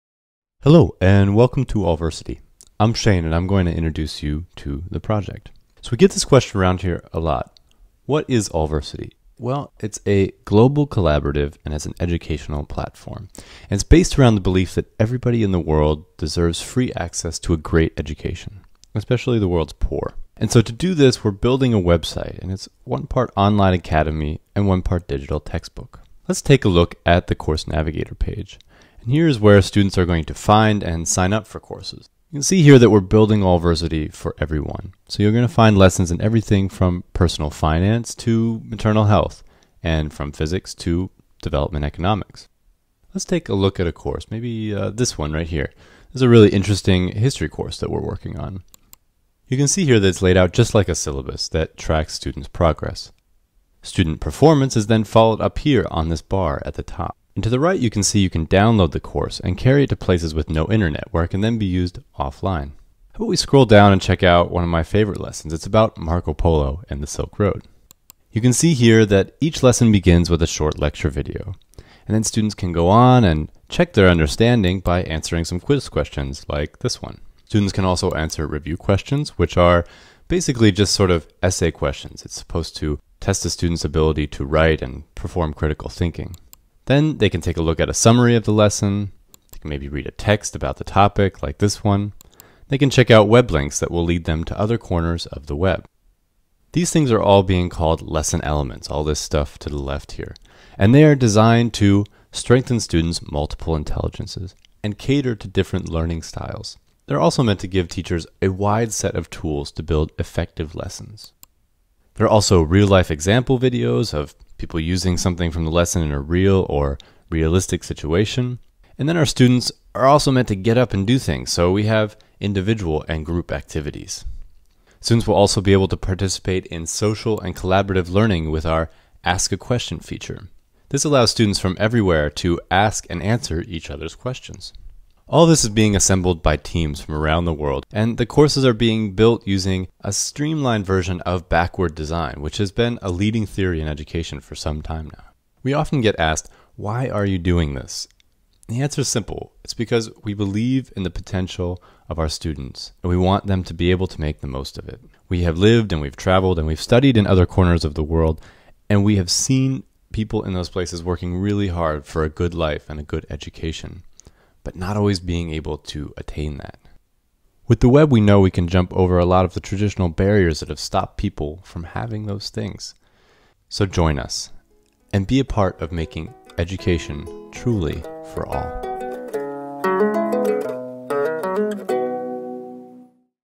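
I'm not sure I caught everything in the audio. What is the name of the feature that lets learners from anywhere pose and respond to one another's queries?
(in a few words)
Ask a Question.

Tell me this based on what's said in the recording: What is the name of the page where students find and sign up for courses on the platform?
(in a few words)
Course Navigator.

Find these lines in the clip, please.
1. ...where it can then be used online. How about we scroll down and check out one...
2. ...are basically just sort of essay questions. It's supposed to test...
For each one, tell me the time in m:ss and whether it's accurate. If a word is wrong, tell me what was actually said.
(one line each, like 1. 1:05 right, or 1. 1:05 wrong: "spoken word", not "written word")
1. 1:01 wrong: "offline", not "online"
2. 1:19 right.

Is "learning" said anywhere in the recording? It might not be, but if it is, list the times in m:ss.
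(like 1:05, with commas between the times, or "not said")
1:45, 2:08.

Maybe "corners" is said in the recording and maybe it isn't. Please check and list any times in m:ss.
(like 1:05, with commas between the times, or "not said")
1:34, 2:37.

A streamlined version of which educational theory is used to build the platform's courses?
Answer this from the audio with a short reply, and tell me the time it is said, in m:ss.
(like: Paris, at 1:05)
backward design, at 2:21.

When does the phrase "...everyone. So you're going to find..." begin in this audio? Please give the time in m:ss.
0:34.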